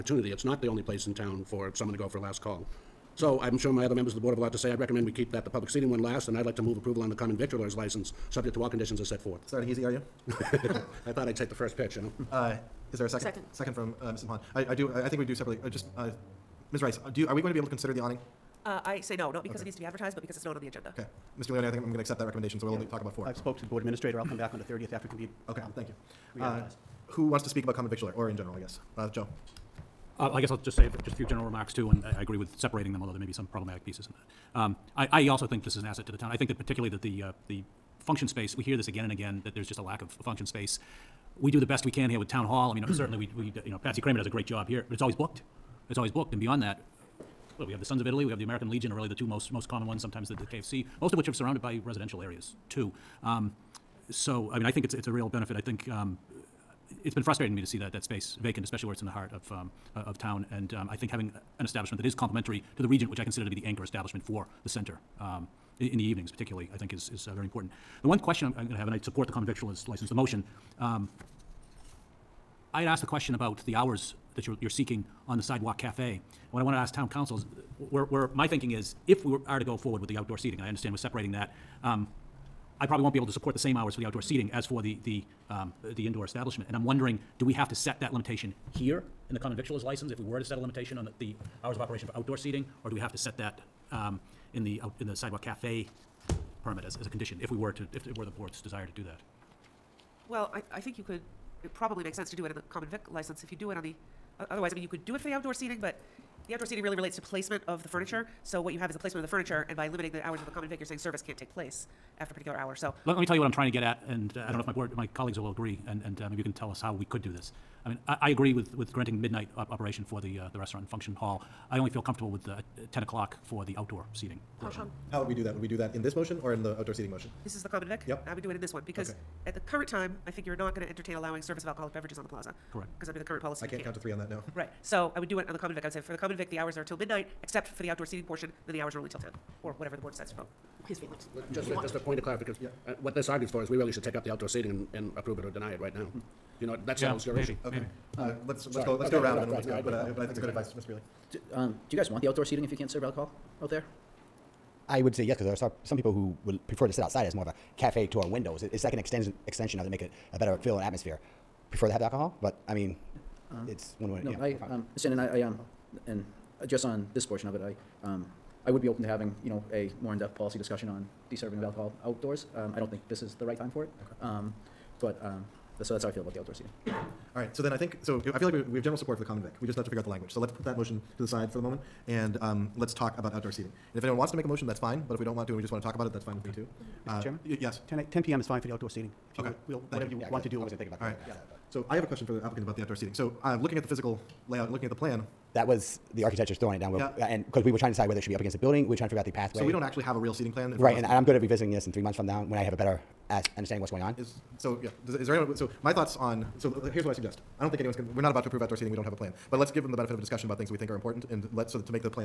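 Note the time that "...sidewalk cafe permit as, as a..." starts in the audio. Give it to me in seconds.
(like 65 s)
95 s.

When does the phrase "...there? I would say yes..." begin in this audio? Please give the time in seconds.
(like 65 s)
153 s.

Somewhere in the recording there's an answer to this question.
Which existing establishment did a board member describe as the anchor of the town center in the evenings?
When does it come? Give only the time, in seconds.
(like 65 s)
62 s.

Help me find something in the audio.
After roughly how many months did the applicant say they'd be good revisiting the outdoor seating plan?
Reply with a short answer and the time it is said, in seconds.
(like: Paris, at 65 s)
3 months, at 201 s.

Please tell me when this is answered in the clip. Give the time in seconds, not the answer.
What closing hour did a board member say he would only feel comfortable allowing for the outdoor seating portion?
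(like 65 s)
122 s.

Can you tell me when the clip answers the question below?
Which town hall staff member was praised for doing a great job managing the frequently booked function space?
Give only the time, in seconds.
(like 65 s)
43 s.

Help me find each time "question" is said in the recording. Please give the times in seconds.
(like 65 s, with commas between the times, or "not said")
68 s, 73 s, 192 s.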